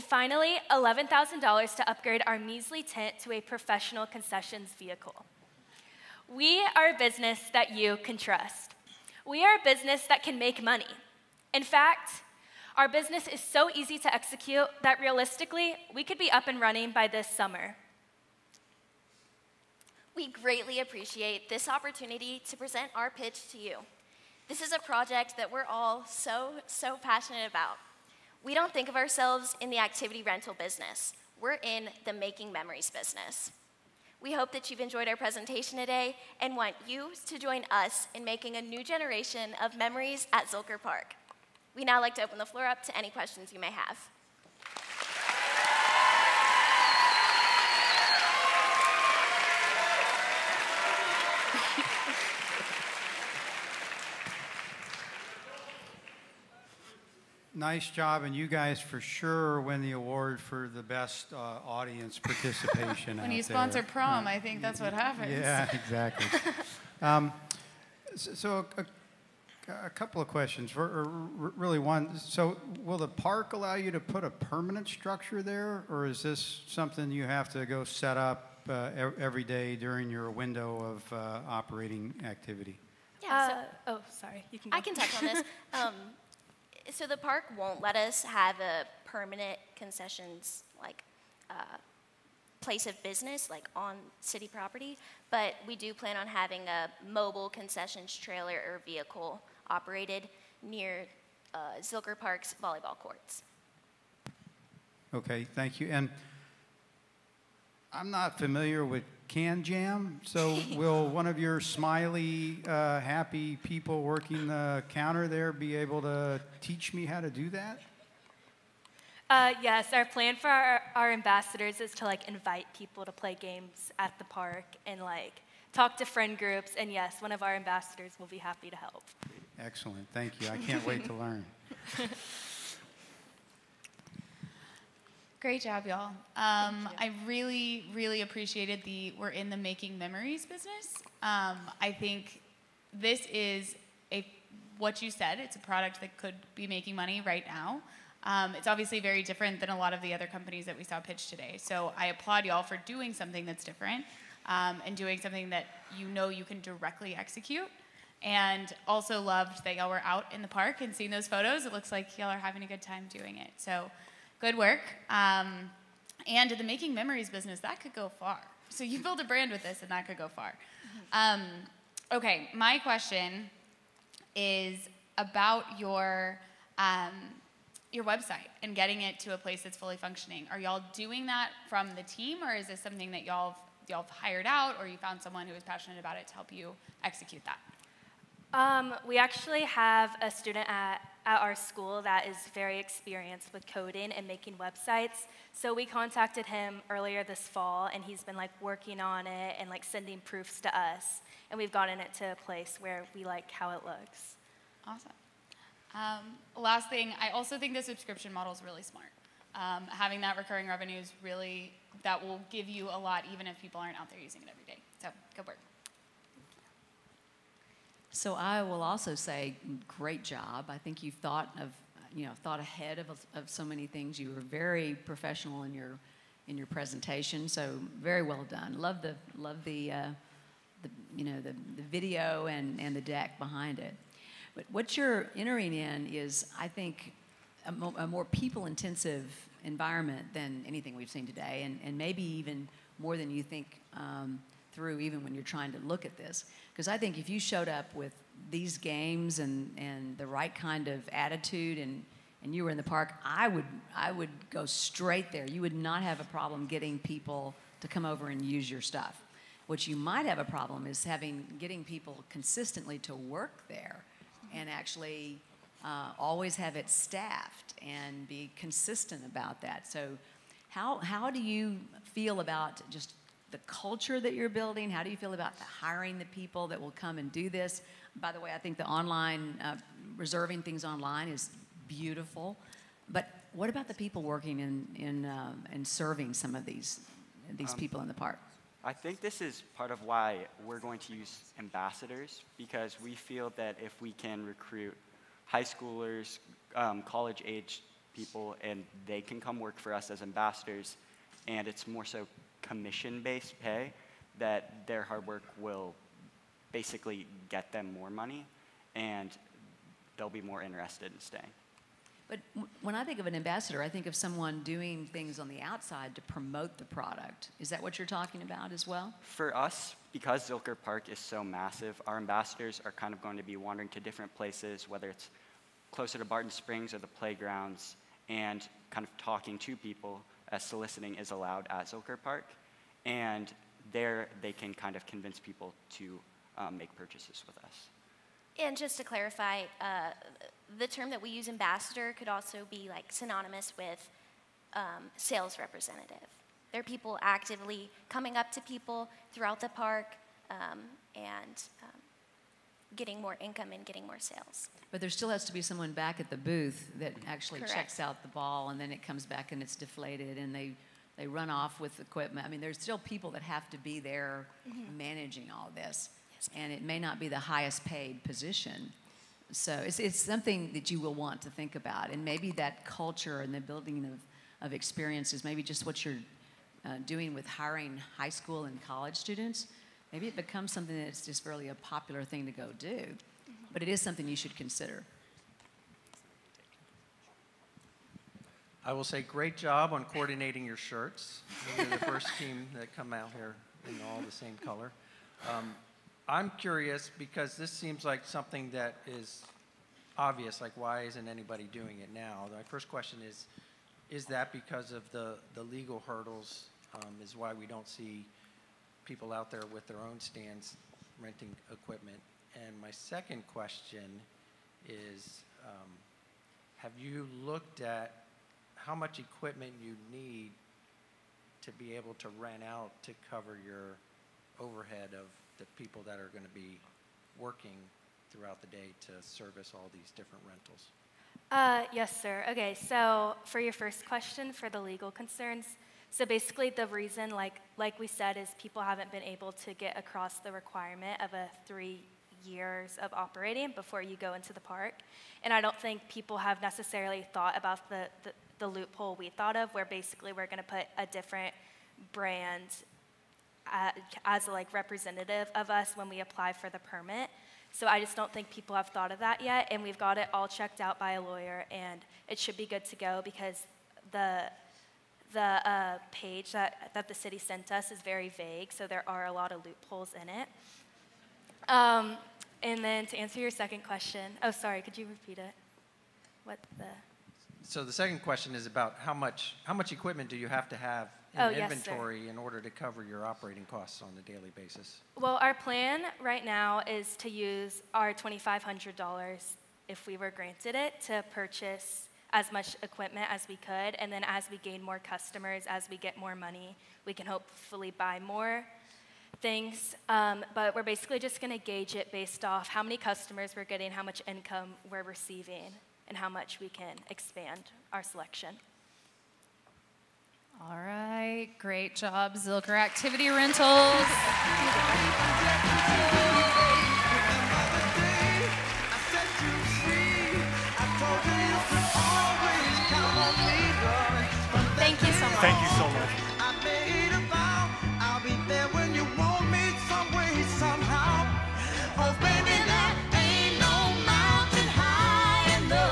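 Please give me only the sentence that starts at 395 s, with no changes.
Um, I'm curious because this seems like something that is obvious, like why isn't anybody doing it now?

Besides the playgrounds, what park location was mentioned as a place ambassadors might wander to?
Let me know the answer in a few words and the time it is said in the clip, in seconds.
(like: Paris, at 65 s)
Barton Springs, at 326 s.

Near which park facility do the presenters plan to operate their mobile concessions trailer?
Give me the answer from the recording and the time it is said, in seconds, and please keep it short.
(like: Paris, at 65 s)
volleyball courts, at 102 s.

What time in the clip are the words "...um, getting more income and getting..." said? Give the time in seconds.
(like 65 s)
351 s.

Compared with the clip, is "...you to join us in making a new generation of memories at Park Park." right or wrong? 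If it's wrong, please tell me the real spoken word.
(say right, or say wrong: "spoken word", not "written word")
wrong: "Zilker", not "Park".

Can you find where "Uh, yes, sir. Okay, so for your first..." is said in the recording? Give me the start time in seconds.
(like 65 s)
431 s.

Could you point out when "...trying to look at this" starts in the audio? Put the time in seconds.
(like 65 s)
245 s.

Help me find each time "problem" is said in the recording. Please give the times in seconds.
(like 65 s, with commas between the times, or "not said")
256 s, 260 s.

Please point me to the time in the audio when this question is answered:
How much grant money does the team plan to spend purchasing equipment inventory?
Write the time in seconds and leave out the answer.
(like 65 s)
488 s.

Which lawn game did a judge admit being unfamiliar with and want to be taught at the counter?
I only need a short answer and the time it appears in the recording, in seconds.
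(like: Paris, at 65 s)
KanJam, at 109 s.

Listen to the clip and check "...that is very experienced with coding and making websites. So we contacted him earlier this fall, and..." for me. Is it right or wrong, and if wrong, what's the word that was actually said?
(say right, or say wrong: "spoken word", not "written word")
right.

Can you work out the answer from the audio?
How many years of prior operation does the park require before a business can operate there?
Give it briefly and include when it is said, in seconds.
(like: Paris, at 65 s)
3, at 441 s.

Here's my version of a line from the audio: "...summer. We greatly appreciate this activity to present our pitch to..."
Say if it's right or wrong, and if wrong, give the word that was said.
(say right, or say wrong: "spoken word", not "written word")
wrong: "opportunity", not "activity".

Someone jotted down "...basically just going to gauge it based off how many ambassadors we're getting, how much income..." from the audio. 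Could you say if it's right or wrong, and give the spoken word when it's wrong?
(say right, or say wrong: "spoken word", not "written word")
wrong: "customers", not "ambassadors".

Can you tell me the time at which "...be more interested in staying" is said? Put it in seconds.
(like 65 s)
310 s.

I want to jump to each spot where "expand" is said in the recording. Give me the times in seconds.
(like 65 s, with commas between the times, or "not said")
507 s.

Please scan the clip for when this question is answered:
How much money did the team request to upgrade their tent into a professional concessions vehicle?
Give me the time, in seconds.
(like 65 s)
0 s.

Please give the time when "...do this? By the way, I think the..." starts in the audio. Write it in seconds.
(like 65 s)
277 s.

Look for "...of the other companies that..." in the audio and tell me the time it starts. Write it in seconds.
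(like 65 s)
149 s.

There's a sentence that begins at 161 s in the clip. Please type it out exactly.
It looks like y'all are having a good time doing it.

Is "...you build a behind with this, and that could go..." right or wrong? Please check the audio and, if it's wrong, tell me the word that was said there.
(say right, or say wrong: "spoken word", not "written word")
wrong: "brand", not "behind".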